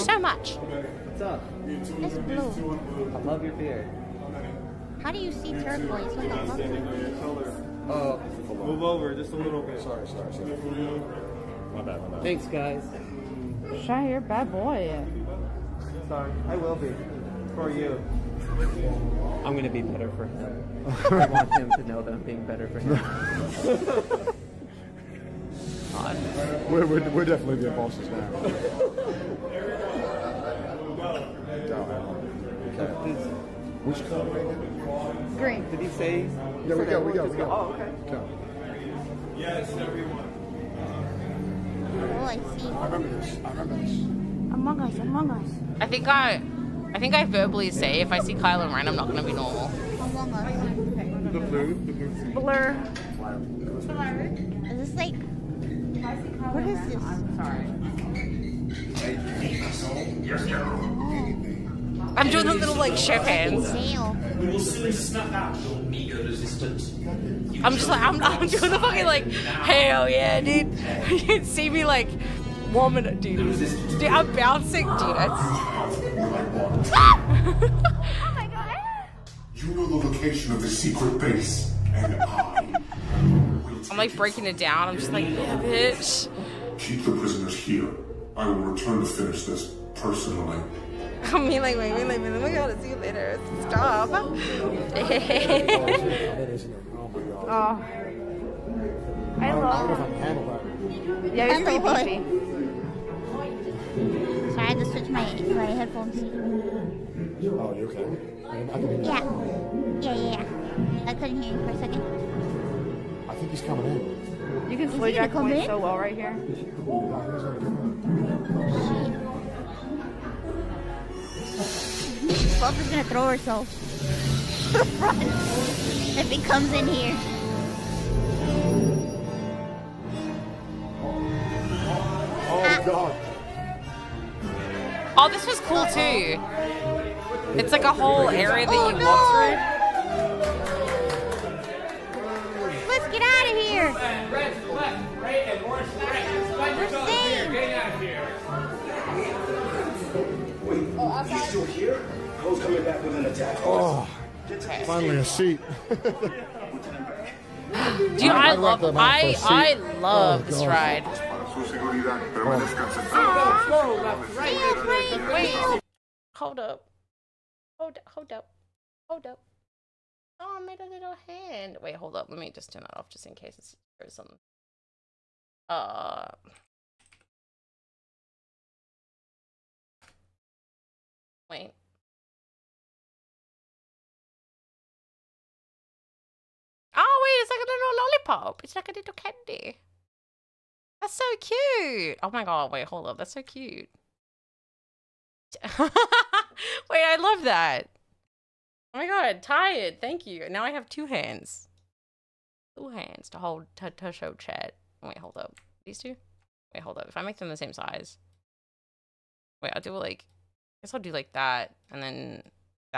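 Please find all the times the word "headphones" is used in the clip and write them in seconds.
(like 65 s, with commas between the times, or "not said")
105 s.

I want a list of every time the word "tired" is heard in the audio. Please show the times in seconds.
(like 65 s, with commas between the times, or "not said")
199 s.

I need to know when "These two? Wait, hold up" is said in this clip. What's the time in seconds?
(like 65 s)
205 s.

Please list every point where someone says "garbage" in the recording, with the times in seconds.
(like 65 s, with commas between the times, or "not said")
not said.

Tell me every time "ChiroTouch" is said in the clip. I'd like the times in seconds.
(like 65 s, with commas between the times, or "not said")
not said.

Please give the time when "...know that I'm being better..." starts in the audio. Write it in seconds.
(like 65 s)
21 s.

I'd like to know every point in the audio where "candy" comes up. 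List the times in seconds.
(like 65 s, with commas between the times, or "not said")
189 s.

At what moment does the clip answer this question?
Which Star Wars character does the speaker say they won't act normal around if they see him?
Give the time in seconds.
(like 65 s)
48 s.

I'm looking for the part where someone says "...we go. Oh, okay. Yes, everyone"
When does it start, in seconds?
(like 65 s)
37 s.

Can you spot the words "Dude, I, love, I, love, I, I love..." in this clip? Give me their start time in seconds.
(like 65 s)
158 s.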